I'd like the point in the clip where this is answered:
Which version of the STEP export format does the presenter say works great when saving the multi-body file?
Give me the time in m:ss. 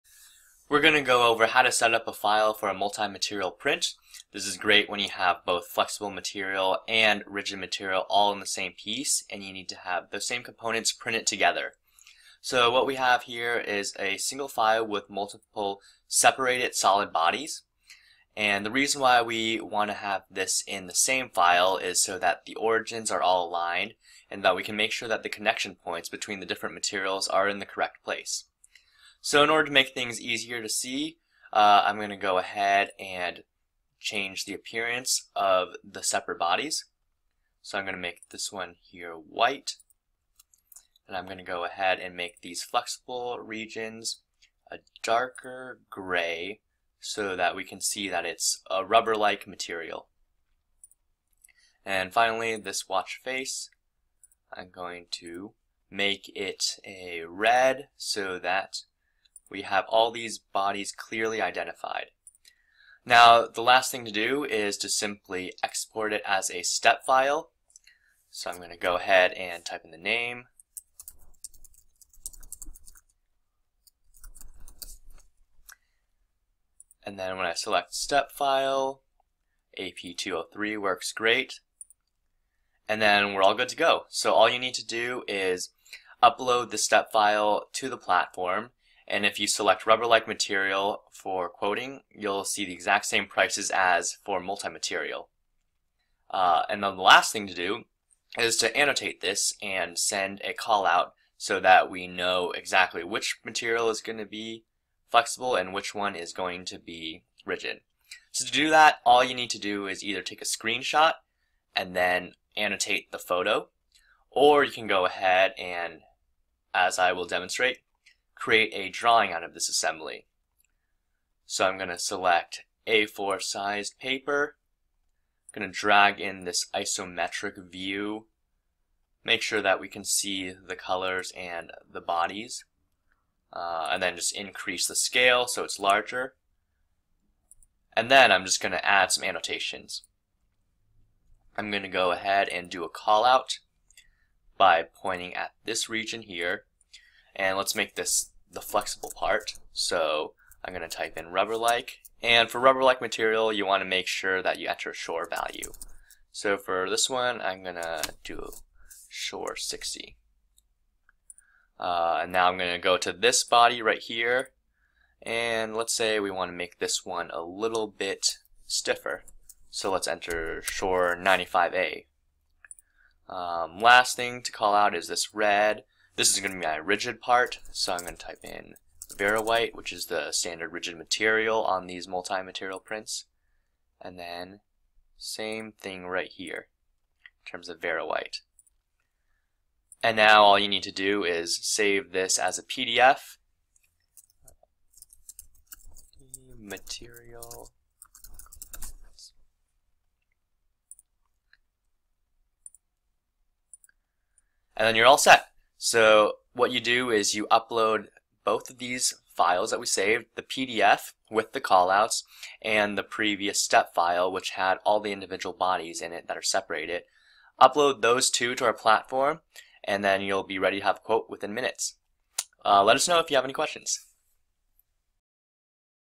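1:19.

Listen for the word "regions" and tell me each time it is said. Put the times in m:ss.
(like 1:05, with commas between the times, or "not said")
0:43, 2:25.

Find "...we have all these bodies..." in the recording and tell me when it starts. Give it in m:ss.
0:59.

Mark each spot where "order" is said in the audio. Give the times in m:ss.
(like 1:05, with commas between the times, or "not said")
0:29.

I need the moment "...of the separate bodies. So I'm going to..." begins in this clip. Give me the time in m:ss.
0:35.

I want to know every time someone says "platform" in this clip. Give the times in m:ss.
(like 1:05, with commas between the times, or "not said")
1:27, 3:38.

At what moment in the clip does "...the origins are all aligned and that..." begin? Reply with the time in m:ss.
0:22.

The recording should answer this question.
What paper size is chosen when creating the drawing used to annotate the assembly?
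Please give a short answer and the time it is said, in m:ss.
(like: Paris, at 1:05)
A4, at 2:02.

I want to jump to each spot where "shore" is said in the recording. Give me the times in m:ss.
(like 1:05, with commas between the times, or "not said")
2:34, 2:39, 2:50.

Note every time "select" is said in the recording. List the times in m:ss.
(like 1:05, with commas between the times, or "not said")
1:17, 1:29, 2:01.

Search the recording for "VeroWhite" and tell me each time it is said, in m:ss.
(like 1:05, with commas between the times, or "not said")
2:59, 3:07.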